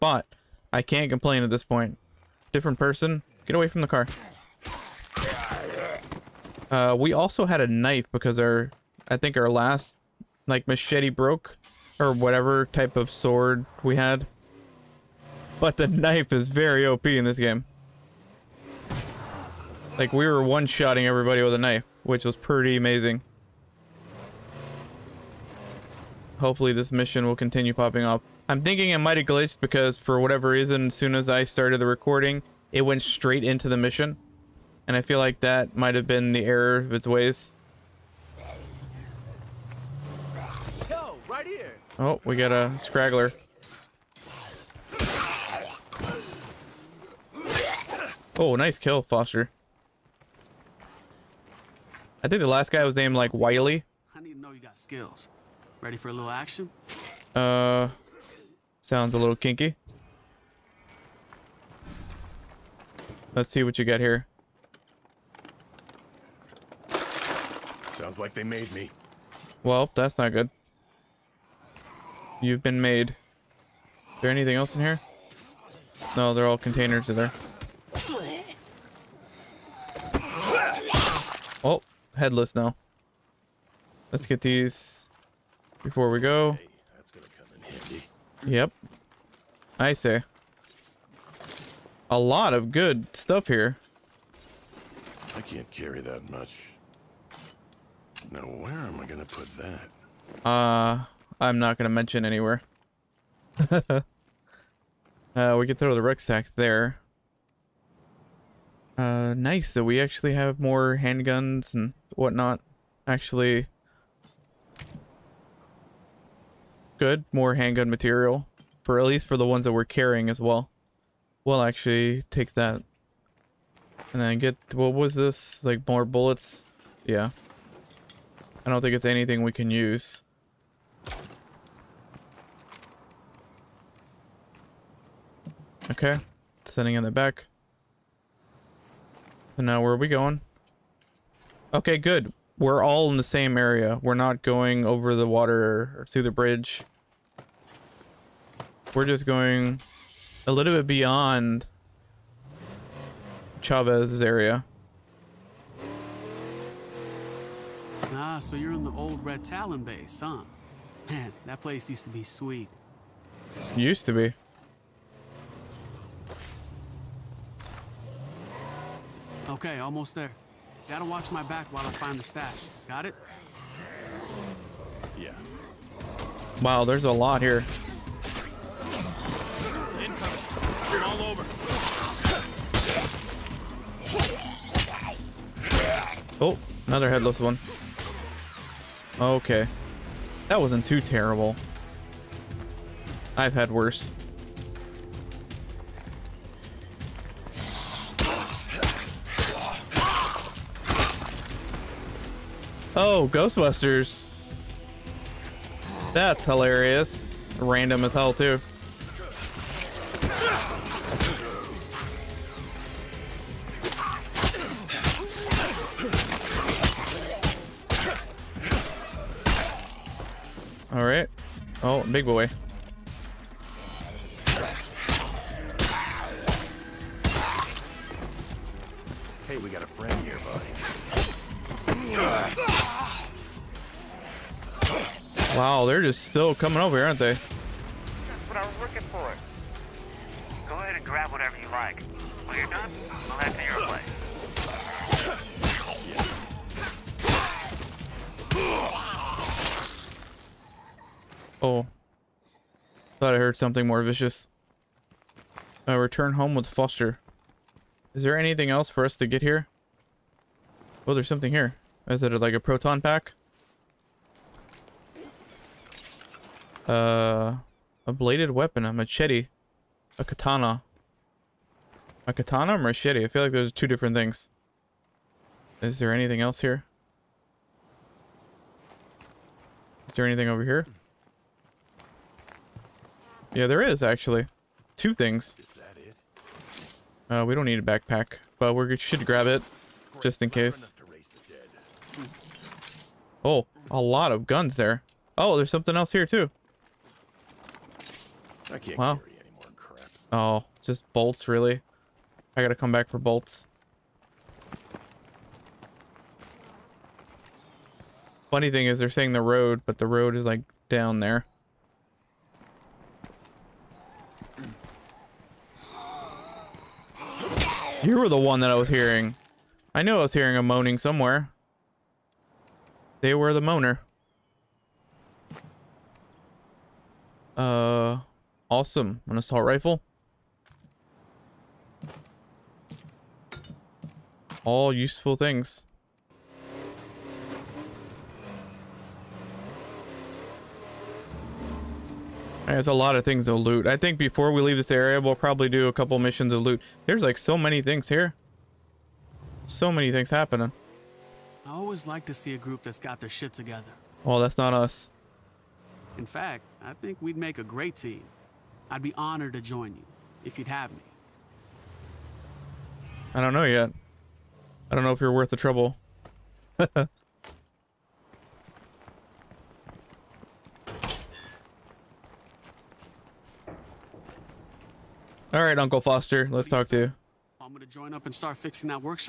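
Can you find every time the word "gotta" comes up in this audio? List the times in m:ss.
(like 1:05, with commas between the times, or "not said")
2:50, 5:02.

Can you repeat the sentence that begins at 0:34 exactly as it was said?
And I feel like that might have been the error of its ways.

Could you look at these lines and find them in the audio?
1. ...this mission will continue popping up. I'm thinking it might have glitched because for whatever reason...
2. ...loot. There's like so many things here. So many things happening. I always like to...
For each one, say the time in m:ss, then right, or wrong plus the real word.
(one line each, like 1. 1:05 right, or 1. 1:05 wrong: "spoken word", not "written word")
1. 0:26 right
2. 5:46 right.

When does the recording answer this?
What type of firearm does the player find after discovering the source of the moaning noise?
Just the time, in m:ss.
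5:29.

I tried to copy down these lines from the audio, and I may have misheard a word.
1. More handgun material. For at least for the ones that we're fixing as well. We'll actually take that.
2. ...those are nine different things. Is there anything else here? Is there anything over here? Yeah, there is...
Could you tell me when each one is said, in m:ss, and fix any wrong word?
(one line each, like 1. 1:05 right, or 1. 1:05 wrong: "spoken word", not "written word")
1. 1:57 wrong: "carrying", not "fixing"
2. 4:33 wrong: "two", not "nine".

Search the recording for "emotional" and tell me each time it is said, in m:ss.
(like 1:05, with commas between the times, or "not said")
not said.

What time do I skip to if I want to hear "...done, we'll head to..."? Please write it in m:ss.
4:02.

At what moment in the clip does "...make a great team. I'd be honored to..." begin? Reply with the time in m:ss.
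5:57.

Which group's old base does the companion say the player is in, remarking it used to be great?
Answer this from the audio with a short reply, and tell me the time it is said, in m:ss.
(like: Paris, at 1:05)
Red Talon, at 2:39.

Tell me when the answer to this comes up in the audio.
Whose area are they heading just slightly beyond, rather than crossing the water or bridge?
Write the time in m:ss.
2:33.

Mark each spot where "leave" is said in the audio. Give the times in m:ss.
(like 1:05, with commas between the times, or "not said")
5:44.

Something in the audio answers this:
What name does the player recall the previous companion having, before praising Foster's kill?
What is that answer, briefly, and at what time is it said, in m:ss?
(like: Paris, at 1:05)
Wiley, at 0:53.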